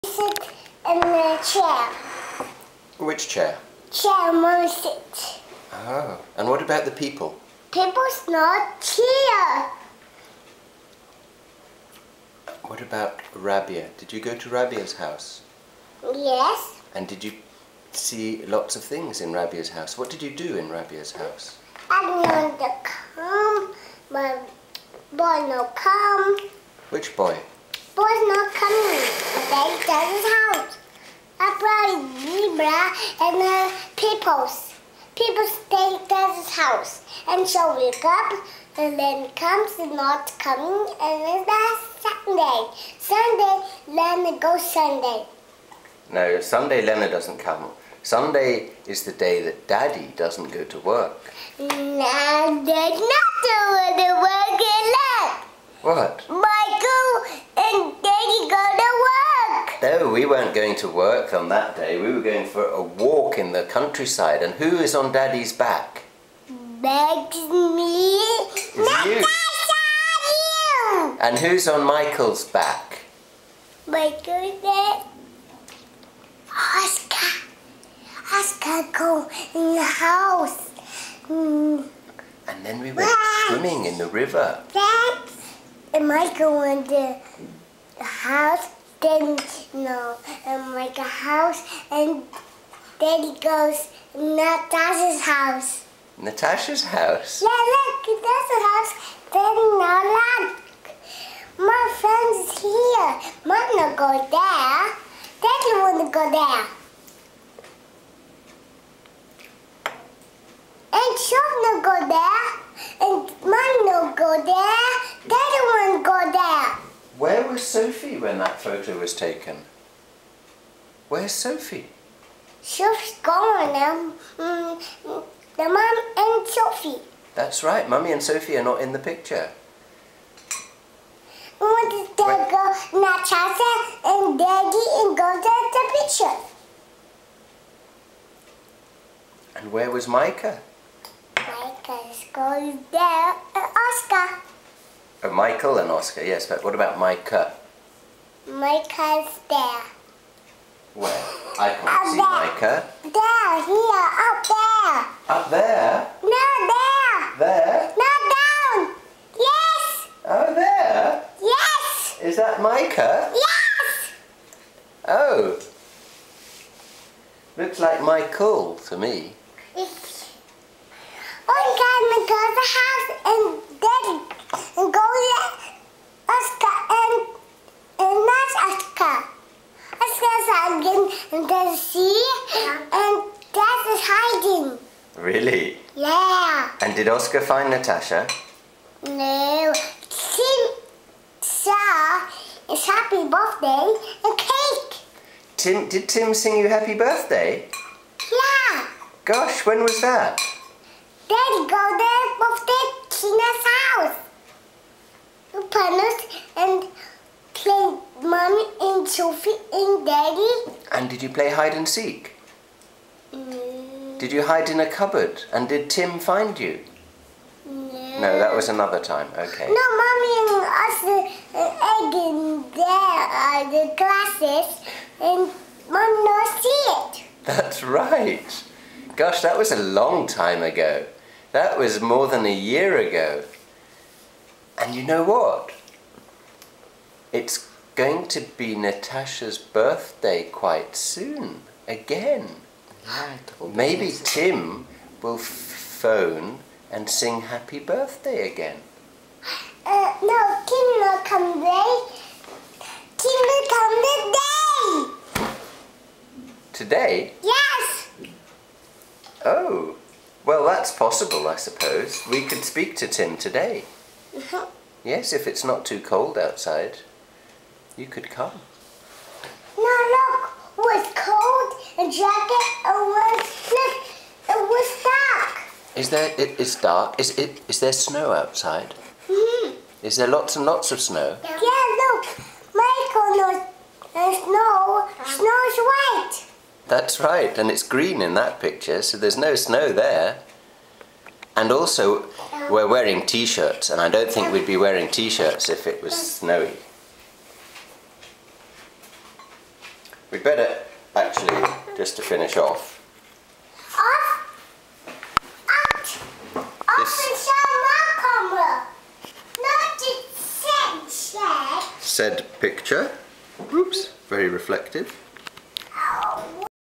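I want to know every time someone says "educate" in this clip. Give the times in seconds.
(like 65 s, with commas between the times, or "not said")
not said.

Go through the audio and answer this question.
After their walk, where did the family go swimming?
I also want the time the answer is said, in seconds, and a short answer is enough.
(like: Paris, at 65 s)
The river, at 84 s.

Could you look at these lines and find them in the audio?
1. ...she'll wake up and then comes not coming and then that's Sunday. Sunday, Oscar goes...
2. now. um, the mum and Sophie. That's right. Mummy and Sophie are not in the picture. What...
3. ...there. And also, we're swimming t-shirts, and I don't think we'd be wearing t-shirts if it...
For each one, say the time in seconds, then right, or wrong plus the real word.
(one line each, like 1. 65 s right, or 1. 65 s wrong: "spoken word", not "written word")
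1. 37 s wrong: "Lena", not "Oscar"
2. 123 s right
3. 289 s wrong: "wearing", not "swimming".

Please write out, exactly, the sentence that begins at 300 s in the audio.
We'd better, actually, just to finish off.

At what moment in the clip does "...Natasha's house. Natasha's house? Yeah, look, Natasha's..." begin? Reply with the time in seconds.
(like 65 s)
94 s.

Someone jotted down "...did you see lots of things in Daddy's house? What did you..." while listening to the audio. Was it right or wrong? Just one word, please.
wrong.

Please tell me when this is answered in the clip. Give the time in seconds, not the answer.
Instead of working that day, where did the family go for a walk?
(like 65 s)
63 s.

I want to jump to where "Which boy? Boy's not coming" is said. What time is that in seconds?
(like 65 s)
26 s.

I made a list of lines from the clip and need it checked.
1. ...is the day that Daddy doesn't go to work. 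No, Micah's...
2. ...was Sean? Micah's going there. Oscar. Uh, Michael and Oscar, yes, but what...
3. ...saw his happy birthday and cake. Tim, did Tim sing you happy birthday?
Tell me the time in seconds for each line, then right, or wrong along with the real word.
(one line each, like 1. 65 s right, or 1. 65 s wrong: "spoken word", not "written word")
1. 48 s wrong: "Daddy", not "Micah"
2. 139 s wrong: "Micah", not "Sean"
3. 191 s right.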